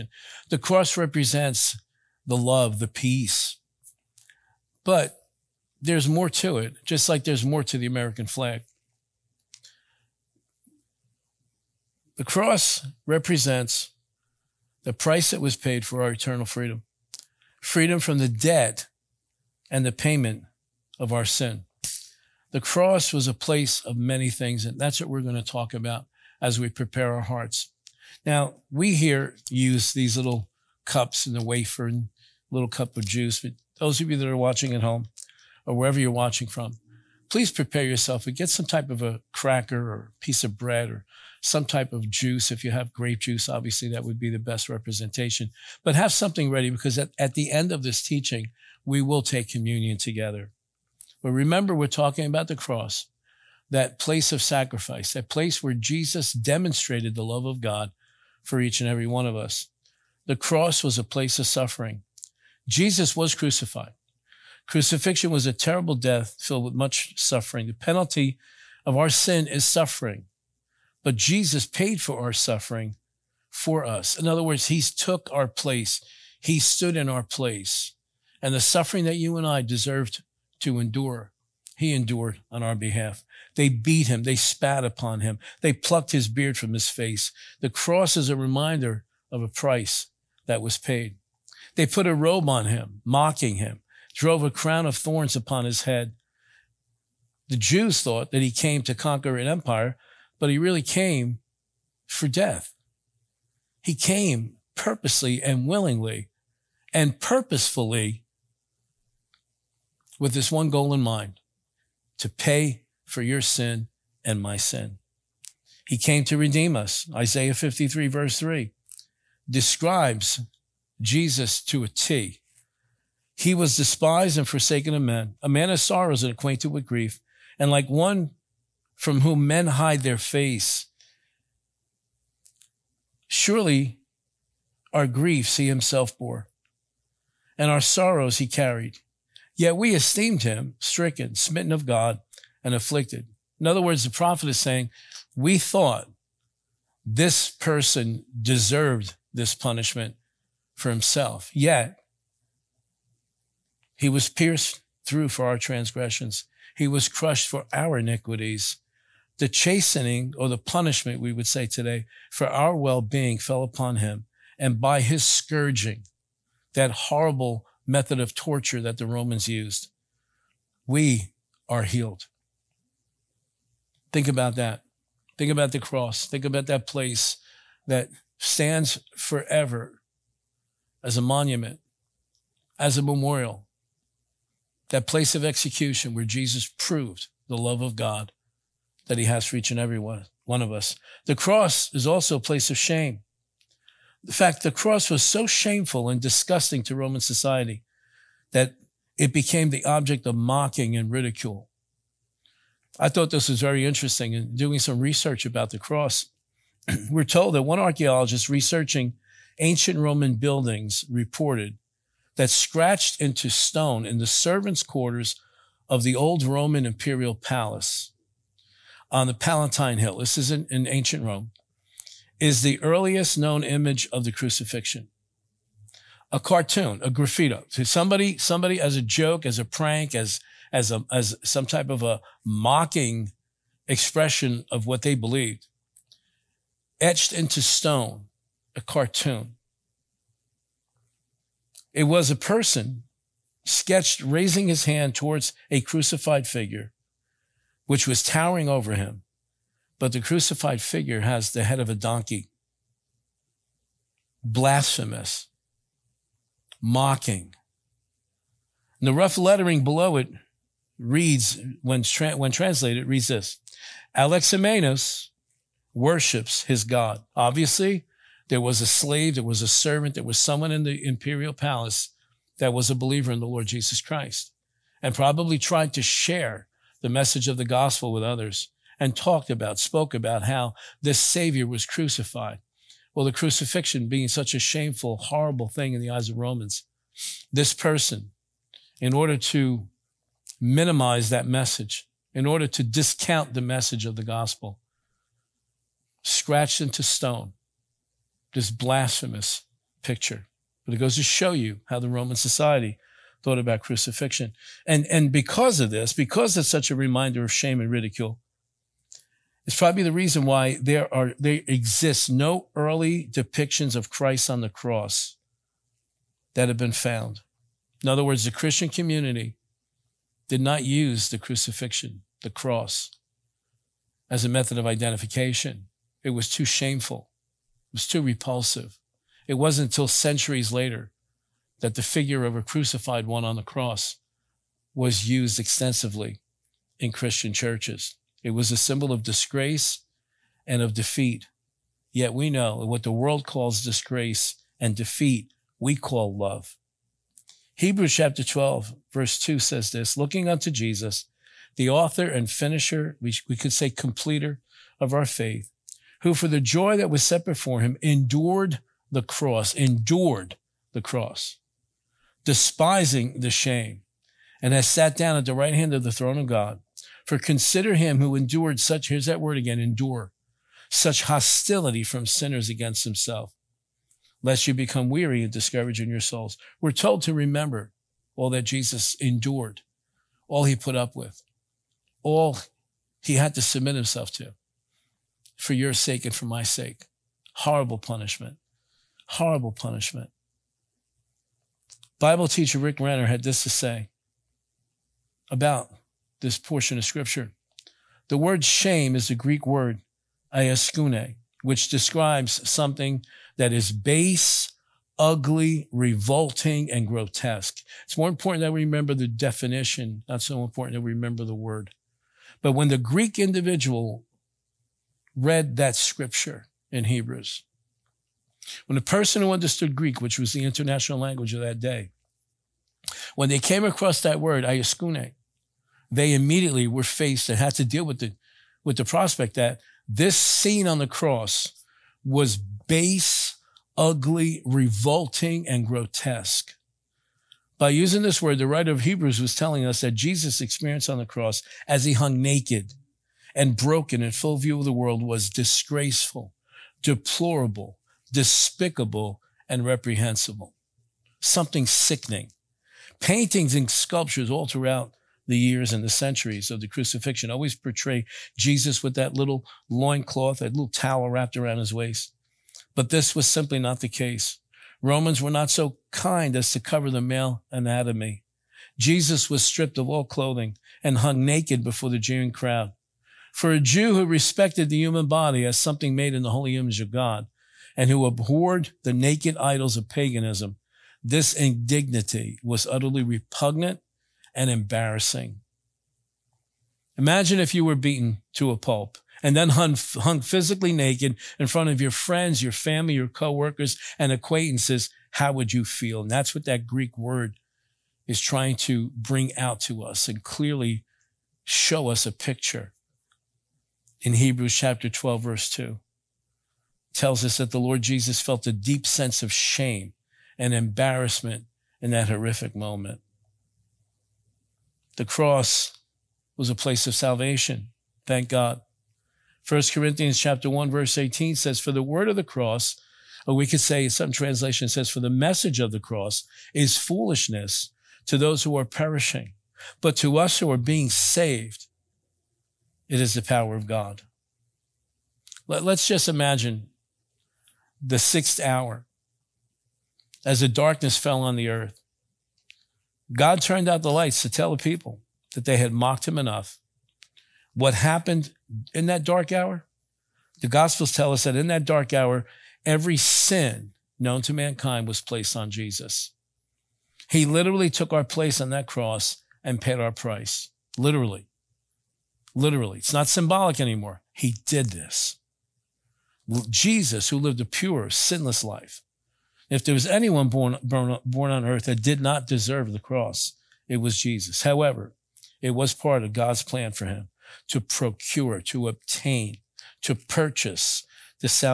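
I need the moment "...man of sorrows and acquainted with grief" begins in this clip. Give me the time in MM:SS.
02:05.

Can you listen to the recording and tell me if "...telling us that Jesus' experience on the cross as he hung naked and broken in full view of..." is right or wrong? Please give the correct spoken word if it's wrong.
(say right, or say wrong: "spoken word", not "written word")
right.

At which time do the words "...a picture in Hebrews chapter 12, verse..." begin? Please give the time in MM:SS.
08:22.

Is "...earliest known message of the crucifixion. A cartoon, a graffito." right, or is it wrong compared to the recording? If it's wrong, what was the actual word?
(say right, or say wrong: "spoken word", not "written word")
wrong: "image", not "message".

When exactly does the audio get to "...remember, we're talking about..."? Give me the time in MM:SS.
00:51.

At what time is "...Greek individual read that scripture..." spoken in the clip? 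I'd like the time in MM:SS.
06:52.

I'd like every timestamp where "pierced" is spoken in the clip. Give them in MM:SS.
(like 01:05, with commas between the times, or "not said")
02:34.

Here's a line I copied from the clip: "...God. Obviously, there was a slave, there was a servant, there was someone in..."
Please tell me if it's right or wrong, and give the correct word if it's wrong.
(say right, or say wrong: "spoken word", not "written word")
right.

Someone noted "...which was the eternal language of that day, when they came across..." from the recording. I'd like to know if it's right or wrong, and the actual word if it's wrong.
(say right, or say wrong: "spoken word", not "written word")
wrong: "international", not "eternal".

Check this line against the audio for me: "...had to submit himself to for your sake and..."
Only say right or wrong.
right.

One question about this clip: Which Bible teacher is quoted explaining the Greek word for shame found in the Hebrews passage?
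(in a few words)
Rick Renner.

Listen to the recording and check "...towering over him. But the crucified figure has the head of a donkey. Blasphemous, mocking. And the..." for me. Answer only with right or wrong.
right.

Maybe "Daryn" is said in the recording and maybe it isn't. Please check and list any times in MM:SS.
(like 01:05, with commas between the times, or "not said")
not said.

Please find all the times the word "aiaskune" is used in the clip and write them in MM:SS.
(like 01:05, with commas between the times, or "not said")
06:40.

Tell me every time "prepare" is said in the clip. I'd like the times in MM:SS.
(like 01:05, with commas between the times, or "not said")
00:26, 00:37.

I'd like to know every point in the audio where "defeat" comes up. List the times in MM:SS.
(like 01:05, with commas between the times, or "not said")
05:40, 05:44.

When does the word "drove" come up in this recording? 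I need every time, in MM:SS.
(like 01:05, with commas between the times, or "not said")
01:34.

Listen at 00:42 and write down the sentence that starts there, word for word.
If you have grape juice, obviously that would be the best representation.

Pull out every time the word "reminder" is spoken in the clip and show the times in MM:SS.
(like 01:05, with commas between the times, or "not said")
01:28, 05:06.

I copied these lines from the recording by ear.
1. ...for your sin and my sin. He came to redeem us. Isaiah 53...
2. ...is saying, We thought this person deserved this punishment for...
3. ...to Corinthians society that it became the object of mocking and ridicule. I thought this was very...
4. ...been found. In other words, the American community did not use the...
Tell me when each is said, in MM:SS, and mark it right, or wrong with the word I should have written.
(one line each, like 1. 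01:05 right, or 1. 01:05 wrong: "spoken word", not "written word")
1. 01:53 right
2. 02:24 right
3. 03:16 wrong: "Roman", not "Corinthians"
4. 05:16 wrong: "Christian", not "American".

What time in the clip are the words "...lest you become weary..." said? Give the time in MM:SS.
06:14.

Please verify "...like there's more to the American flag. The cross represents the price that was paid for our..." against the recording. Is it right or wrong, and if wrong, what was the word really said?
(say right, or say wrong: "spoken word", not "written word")
right.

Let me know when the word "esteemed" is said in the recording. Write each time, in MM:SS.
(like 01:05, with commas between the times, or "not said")
02:19.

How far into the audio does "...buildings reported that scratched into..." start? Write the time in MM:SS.
03:30.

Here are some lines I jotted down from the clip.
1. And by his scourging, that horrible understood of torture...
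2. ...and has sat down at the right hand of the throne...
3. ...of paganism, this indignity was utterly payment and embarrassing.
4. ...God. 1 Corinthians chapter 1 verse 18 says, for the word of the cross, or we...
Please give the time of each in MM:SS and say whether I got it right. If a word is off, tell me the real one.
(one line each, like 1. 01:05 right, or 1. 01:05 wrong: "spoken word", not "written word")
1. 02:44 wrong: "method", not "understood"
2. 06:04 right
3. 07:59 wrong: "repugnant", not "payment"
4. 08:38 right.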